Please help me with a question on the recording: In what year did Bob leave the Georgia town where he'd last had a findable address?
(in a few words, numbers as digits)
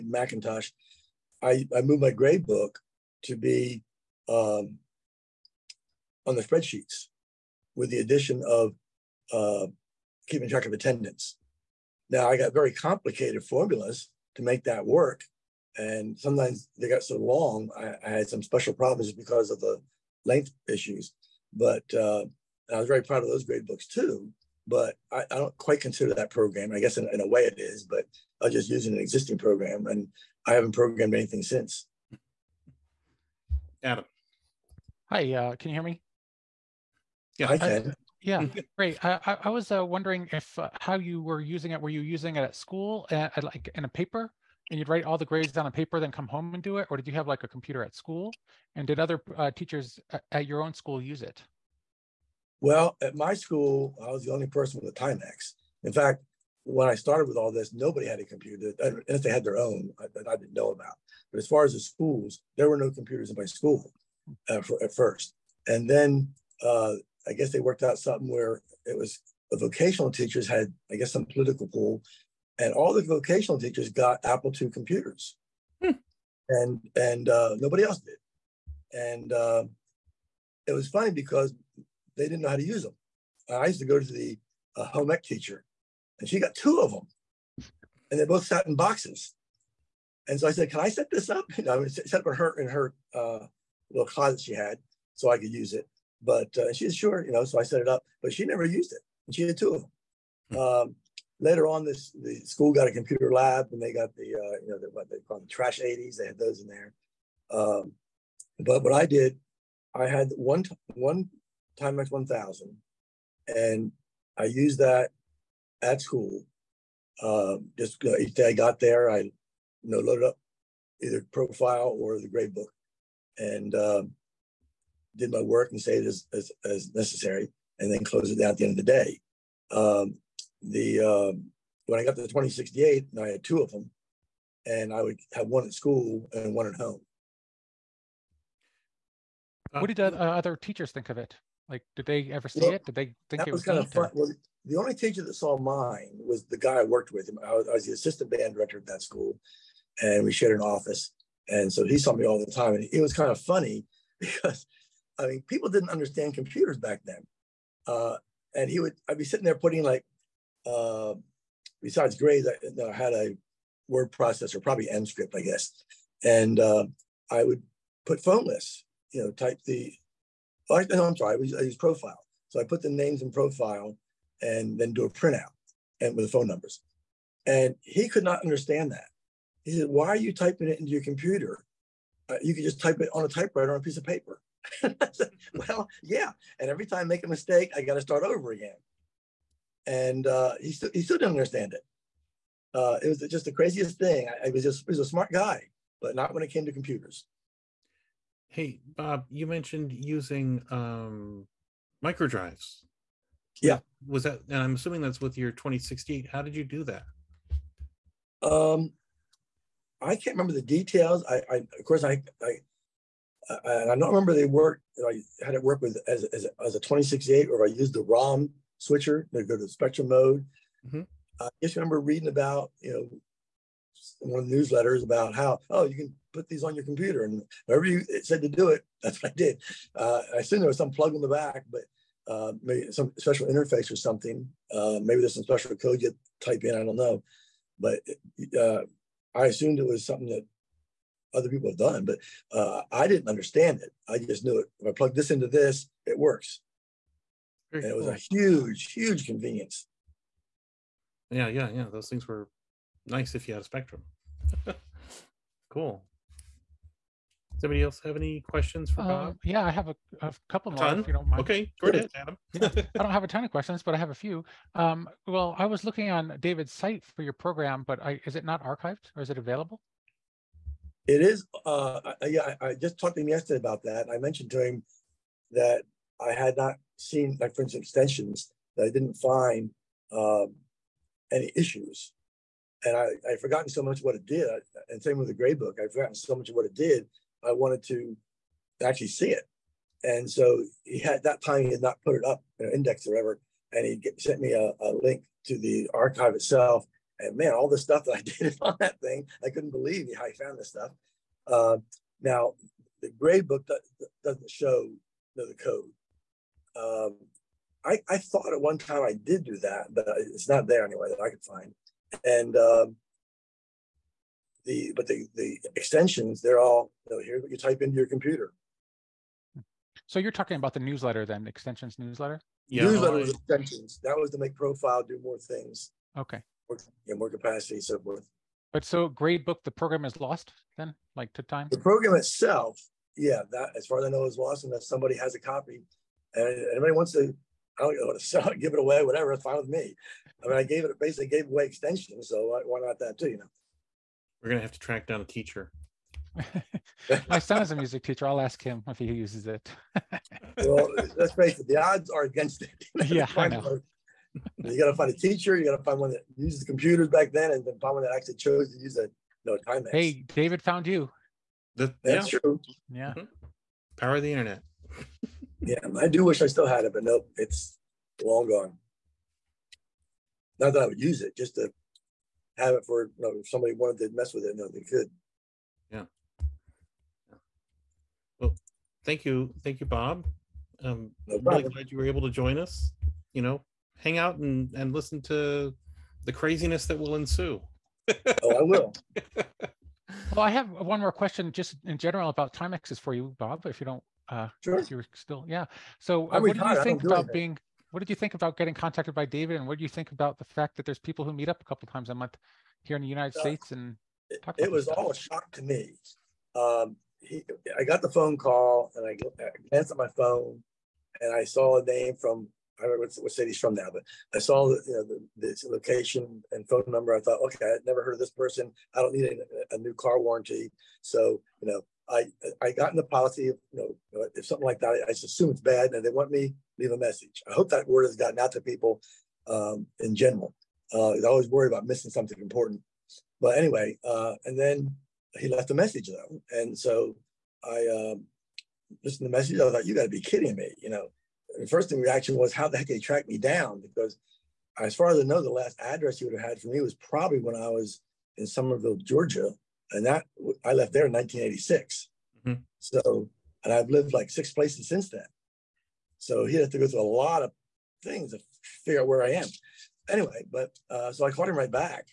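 1986.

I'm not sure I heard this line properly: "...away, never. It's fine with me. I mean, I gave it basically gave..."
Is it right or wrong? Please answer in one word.
wrong.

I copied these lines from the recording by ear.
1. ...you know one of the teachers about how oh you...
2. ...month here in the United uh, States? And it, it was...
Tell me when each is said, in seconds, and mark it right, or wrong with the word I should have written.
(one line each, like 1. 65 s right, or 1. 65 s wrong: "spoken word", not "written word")
1. 222 s wrong: "newsletters", not "teachers"
2. 402 s right.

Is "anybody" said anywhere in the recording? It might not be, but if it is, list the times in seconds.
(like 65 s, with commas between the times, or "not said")
257 s, 336 s.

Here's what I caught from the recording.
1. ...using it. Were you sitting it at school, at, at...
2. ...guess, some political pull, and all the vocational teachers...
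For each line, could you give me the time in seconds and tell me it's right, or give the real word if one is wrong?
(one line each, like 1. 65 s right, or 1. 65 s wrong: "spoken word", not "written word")
1. 41 s wrong: "using", not "sitting"
2. 70 s right.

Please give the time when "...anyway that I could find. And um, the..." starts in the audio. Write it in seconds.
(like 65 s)
310 s.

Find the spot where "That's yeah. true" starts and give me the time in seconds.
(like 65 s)
361 s.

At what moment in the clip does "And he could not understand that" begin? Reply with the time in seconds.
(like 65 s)
177 s.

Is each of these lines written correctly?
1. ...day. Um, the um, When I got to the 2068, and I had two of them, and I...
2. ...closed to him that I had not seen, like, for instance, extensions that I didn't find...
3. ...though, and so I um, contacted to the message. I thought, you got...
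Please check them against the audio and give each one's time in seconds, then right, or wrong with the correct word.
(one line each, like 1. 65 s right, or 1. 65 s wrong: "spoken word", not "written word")
1. 128 s right
2. 274 s wrong: "mentioned", not "closed"
3. 436 s wrong: "listened", not "contacted".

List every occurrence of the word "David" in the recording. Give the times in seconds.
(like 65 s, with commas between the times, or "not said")
266 s, 360 s, 399 s.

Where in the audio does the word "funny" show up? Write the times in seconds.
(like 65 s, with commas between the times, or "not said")
80 s, 153 s.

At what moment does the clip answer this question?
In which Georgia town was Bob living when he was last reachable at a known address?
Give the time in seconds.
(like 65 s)
448 s.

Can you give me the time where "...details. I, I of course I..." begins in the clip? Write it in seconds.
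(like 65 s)
210 s.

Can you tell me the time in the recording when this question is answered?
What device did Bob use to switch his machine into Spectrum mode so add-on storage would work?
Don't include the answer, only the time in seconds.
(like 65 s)
218 s.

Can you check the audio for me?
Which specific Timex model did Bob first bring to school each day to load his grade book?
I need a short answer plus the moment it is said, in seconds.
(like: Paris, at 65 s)
Timex 1000, at 111 s.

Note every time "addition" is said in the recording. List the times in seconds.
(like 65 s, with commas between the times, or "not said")
7 s.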